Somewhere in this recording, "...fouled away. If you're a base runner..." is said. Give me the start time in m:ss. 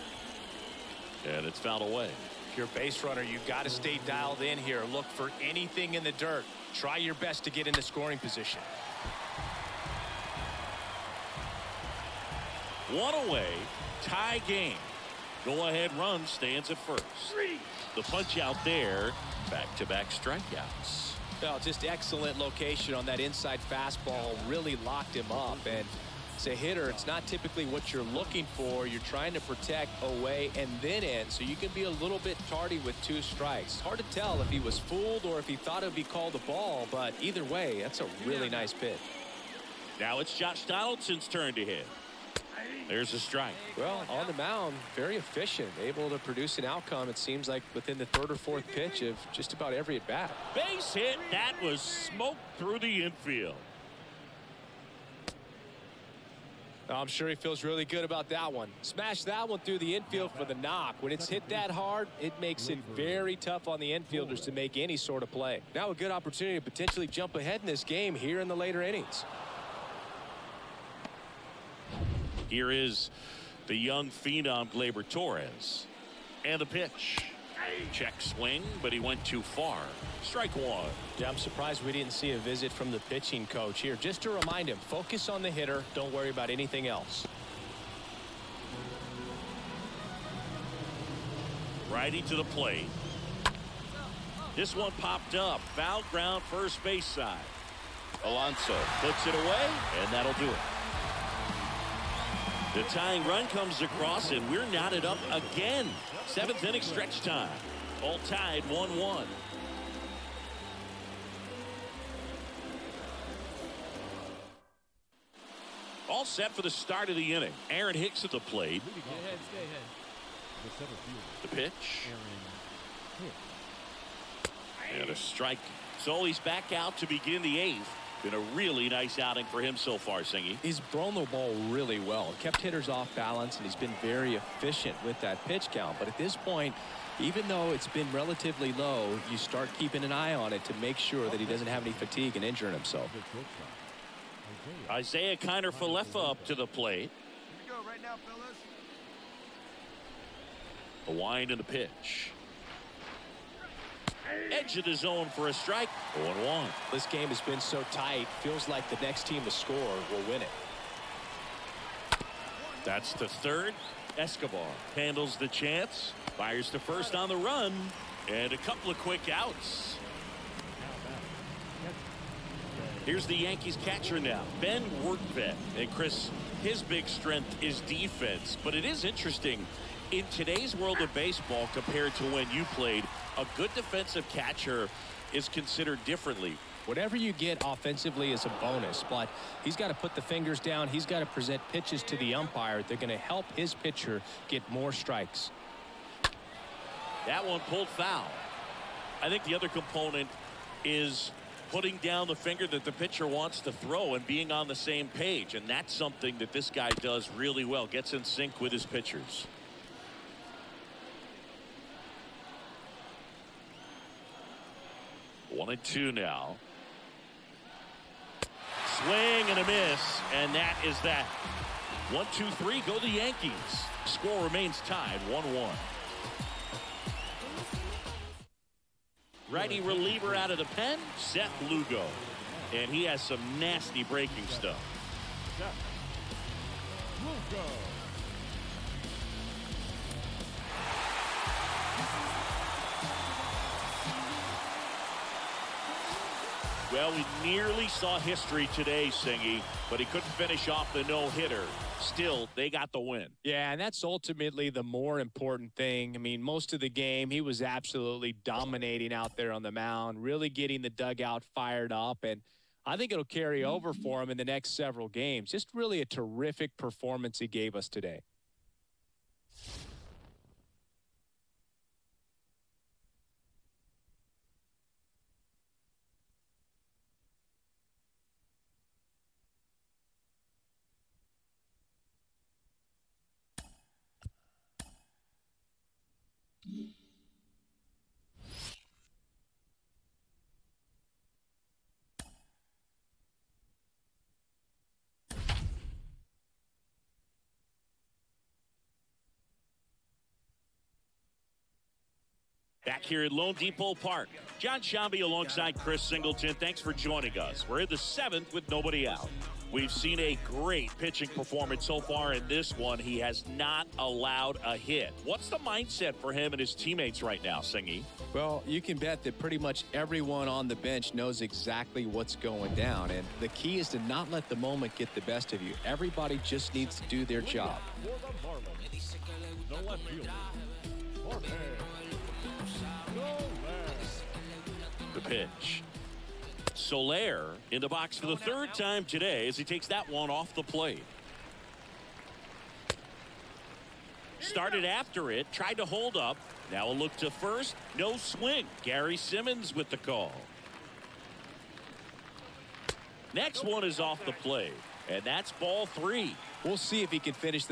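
0:01.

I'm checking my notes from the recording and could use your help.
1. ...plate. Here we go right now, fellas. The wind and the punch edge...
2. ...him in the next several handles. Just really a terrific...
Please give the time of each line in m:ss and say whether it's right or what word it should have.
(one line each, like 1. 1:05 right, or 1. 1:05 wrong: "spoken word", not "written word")
1. 2:26 wrong: "pitch", not "punch"
2. 4:24 wrong: "games", not "handles".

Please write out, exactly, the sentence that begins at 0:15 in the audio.
Go ahead run stands at first.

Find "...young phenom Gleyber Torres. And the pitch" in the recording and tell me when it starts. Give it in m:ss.
1:13.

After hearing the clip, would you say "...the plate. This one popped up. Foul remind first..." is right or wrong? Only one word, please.
wrong.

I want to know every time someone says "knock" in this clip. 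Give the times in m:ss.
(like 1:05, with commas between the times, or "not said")
1:00.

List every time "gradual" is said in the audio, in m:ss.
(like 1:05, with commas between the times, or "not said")
not said.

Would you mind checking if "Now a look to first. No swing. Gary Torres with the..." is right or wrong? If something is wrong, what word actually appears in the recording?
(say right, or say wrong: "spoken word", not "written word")
wrong: "Simmons", not "Torres".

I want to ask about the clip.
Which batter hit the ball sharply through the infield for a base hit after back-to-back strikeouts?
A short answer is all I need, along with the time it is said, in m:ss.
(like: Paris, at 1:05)
Josh Donaldson, at 0:40.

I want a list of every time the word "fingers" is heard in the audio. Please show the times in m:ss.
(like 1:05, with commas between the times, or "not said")
3:10, 3:22.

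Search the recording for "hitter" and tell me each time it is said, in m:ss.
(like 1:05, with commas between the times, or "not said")
0:26, 1:25, 2:12, 4:11.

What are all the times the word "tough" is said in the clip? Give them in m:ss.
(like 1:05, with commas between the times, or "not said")
1:03.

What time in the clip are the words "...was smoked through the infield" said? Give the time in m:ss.
0:51.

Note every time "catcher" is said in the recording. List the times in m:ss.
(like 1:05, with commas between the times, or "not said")
2:53, 3:04.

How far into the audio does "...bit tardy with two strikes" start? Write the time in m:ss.
0:32.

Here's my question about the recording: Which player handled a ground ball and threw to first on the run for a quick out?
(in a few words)
Escobar.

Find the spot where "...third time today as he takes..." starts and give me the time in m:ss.
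5:38.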